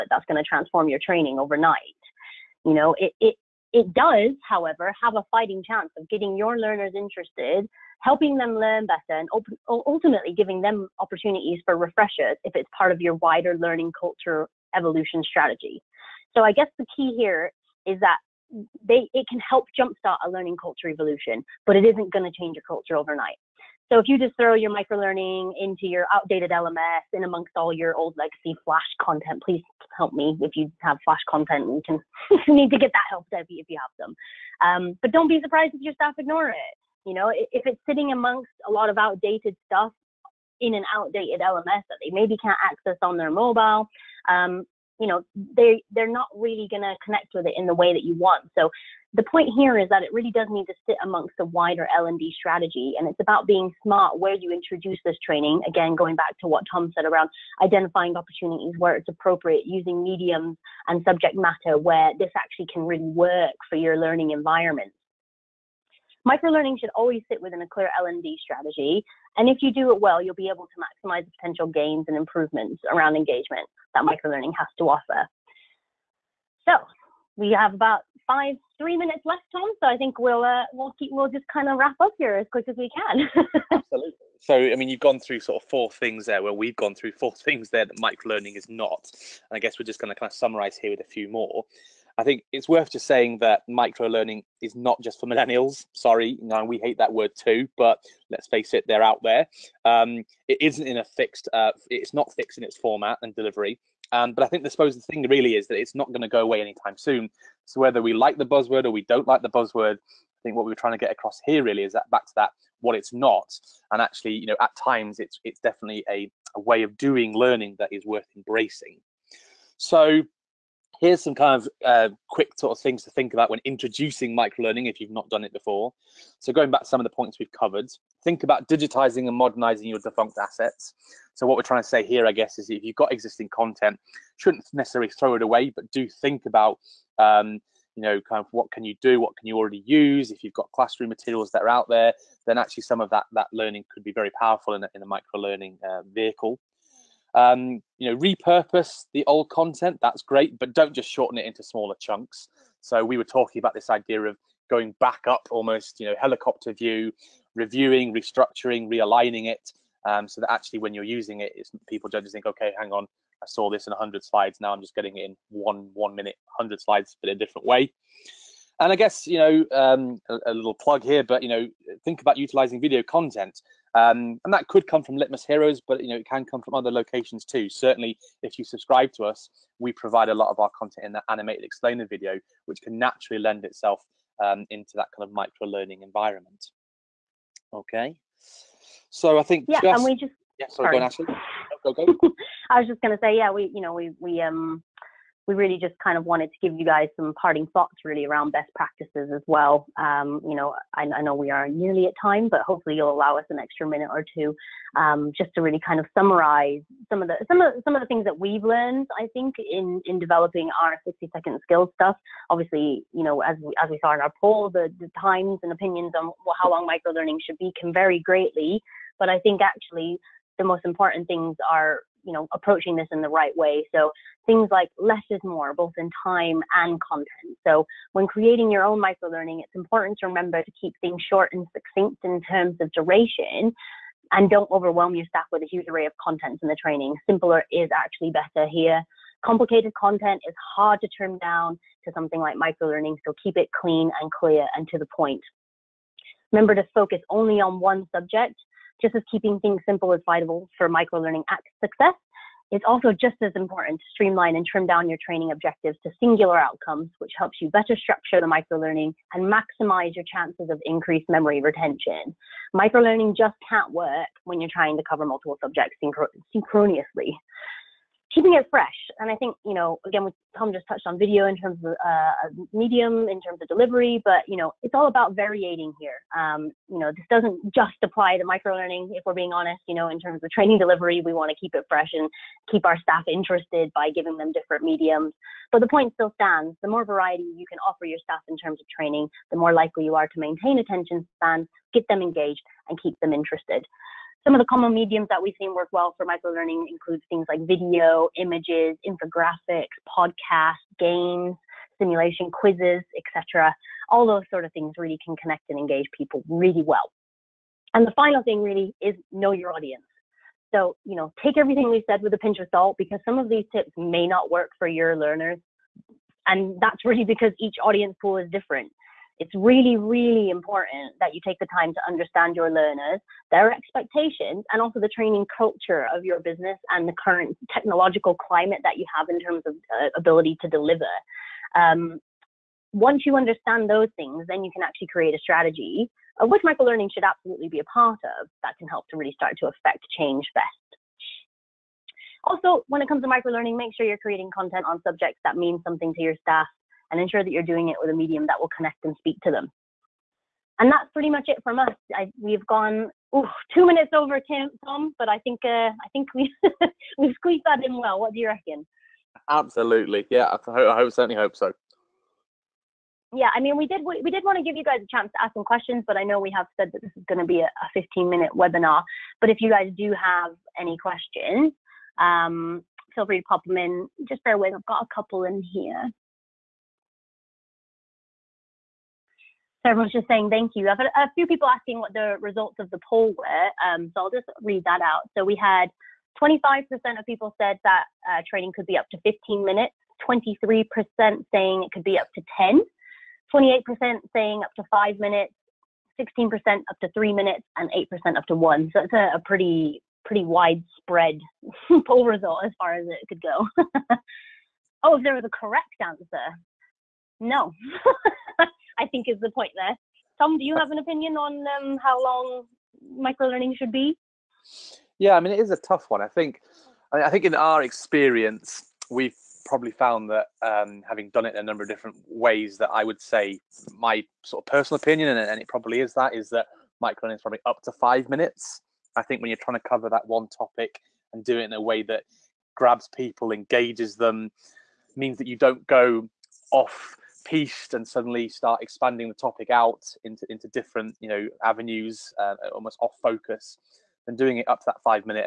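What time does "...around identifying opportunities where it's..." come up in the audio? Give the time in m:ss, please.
0:57.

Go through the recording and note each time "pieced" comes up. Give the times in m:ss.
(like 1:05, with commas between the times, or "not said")
7:17.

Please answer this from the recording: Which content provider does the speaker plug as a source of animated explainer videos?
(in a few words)
Litmos Heroes.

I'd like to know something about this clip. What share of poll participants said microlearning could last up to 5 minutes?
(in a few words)
28%.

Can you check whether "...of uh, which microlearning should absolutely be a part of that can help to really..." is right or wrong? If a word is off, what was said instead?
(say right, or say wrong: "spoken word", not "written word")
right.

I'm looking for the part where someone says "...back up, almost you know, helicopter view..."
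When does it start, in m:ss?
2:34.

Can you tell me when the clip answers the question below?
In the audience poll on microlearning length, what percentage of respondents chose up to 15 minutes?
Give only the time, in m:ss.
6:26.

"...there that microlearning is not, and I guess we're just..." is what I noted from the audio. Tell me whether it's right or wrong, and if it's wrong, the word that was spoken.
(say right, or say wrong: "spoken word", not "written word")
right.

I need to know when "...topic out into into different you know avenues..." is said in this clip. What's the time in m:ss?
7:19.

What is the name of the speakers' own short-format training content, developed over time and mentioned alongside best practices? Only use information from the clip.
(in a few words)
60 second skill.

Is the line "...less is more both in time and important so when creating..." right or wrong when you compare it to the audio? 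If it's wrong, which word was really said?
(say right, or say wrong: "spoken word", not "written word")
wrong: "content", not "important".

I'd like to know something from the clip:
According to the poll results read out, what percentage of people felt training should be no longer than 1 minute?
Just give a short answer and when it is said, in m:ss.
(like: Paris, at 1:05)
8%, at 6:37.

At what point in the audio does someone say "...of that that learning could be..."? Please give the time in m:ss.
2:22.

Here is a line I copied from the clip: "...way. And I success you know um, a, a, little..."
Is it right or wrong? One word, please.
wrong.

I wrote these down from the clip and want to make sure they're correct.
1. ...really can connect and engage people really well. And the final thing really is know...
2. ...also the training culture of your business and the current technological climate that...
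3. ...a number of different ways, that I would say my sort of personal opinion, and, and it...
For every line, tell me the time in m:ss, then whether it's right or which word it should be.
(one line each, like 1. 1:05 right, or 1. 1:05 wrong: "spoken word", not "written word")
1. 5:04 right
2. 5:24 right
3. 7:01 right.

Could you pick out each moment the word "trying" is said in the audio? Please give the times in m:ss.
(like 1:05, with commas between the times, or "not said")
1:50, 2:11, 4:24, 7:09.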